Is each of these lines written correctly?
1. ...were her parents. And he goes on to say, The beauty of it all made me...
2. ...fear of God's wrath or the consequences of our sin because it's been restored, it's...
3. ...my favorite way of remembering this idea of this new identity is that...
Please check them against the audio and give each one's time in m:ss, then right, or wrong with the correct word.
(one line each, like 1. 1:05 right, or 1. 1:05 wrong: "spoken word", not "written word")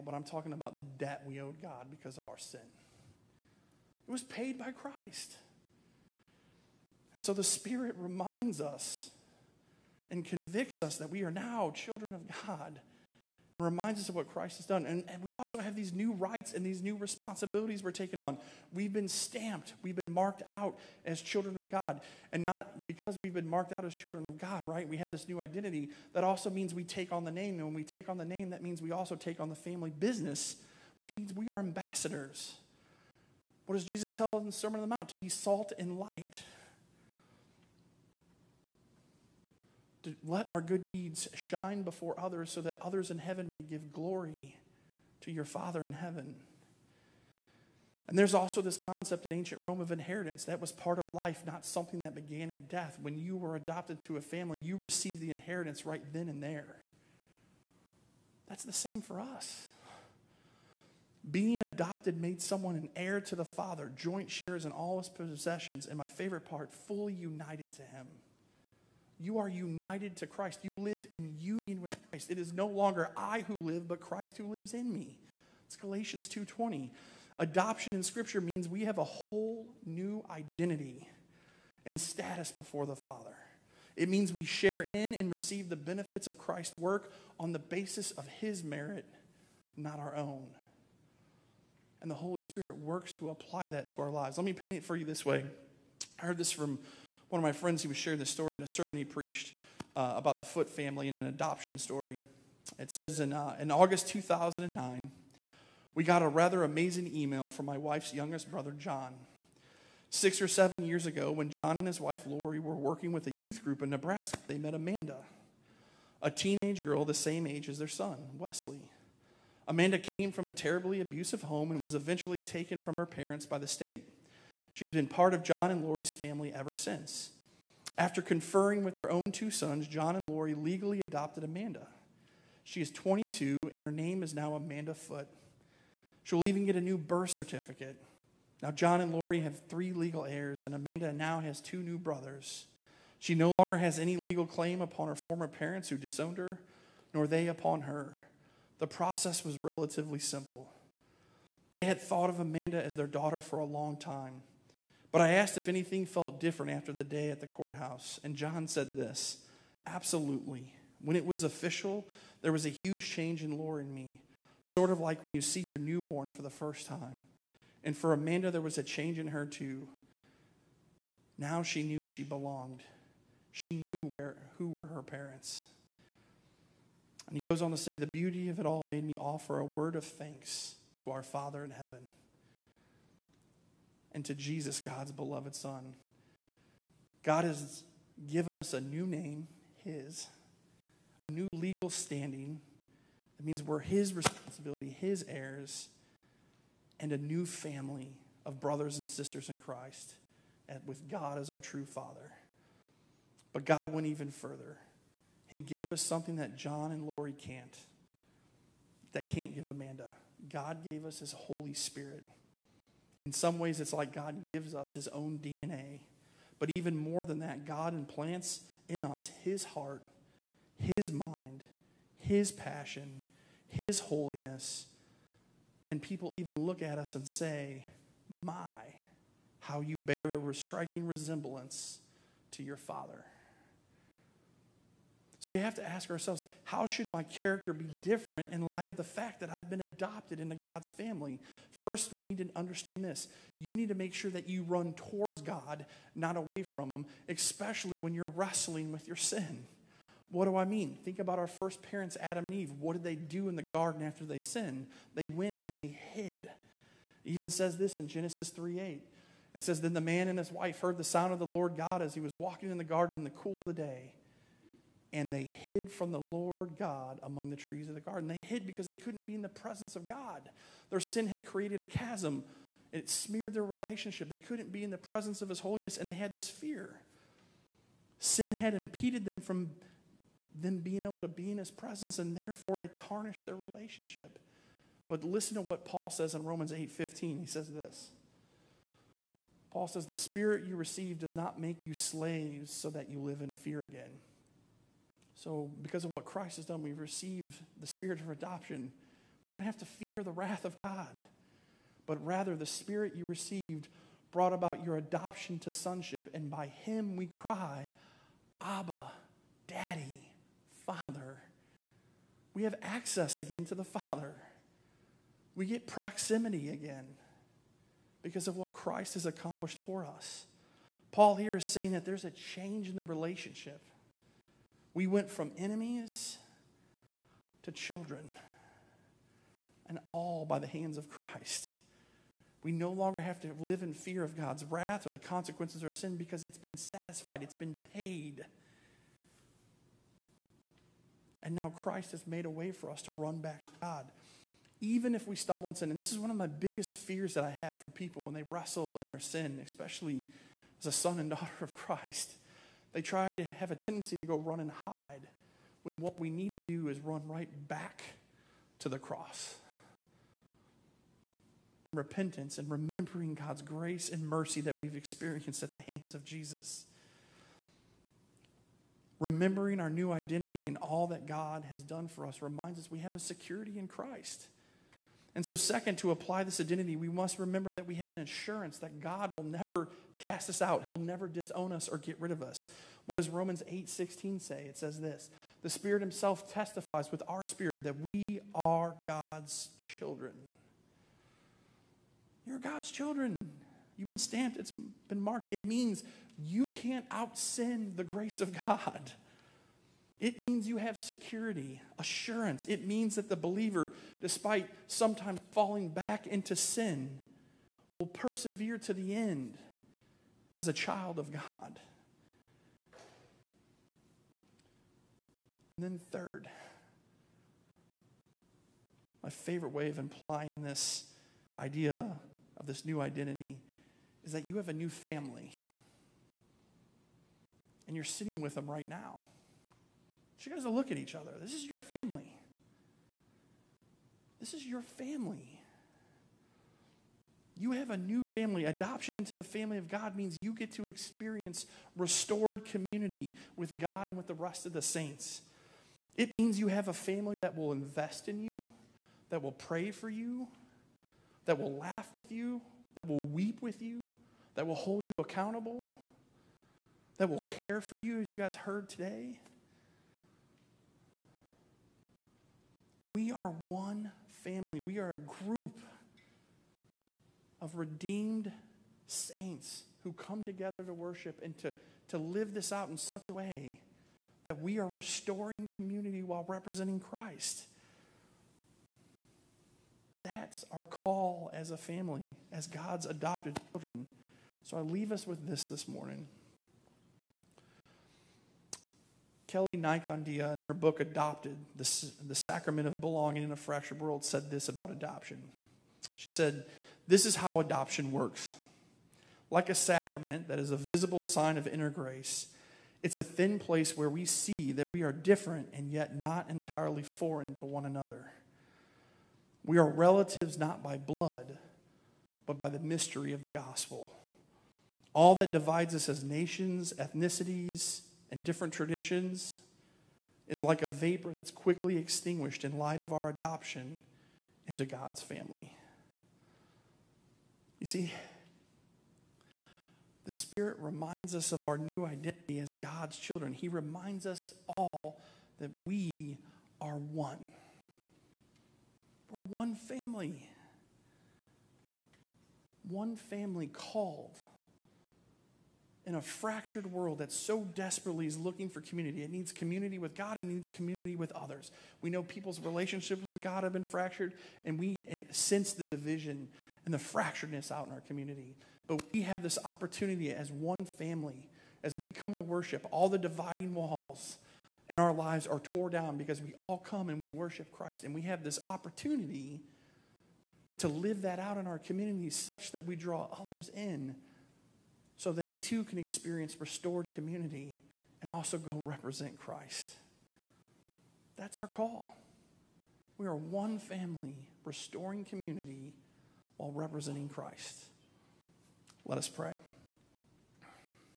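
1. 2:54 right
2. 5:33 wrong: "satisfied", not "restored"
3. 6:59 wrong: "implying", not "remembering".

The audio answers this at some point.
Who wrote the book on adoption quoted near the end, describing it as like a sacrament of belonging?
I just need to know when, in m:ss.
8:09.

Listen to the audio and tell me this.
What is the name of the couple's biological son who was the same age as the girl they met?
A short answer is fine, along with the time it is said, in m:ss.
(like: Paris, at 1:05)
Wesley, at 1:58.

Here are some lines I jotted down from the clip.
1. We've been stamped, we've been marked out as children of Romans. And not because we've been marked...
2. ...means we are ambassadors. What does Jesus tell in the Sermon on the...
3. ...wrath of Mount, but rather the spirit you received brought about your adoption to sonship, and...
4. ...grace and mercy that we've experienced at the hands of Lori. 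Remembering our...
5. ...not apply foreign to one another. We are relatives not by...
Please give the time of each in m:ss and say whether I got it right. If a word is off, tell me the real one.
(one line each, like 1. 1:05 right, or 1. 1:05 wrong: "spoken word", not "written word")
1. 0:18 wrong: "God", not "Romans"
2. 0:31 right
3. 5:00 wrong: "God", not "Mount"
4. 6:03 wrong: "Jesus", not "Lori"
5. 8:26 wrong: "entirely", not "apply".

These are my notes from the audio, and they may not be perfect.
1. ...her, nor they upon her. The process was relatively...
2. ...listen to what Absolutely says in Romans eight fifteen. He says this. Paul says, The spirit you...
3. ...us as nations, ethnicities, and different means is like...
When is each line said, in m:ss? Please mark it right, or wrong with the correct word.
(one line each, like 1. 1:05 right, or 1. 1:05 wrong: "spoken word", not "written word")
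1. 2:26 right
2. 4:45 wrong: "Paul", not "Absolutely"
3. 8:35 wrong: "traditions", not "means".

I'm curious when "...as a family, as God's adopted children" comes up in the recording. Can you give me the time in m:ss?
8:01.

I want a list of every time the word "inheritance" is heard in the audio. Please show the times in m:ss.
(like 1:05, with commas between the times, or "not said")
0:49, 0:55.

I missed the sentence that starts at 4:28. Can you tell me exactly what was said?
They hid because they couldn't be in the presence of God.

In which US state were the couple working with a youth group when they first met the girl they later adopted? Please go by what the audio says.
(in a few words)
Nebraska.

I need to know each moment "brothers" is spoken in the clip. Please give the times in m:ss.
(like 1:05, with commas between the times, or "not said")
1:48, 2:21, 3:18.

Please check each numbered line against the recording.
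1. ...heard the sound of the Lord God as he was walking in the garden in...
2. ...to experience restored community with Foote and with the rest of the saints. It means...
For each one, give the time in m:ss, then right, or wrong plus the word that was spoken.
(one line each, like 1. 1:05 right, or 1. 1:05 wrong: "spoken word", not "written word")
1. 4:20 right
2. 7:20 wrong: "God", not "Foote".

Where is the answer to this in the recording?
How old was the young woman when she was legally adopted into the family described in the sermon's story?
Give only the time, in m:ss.
2:12.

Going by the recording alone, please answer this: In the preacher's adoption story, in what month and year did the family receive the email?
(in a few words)
August 2009.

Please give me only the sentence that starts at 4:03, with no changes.
You need to make sure that you run towards God, not away from Him, especially when you're wrestling with your sin.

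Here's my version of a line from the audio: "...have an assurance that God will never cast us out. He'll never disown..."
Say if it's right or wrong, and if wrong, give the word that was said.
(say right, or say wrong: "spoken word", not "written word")
right.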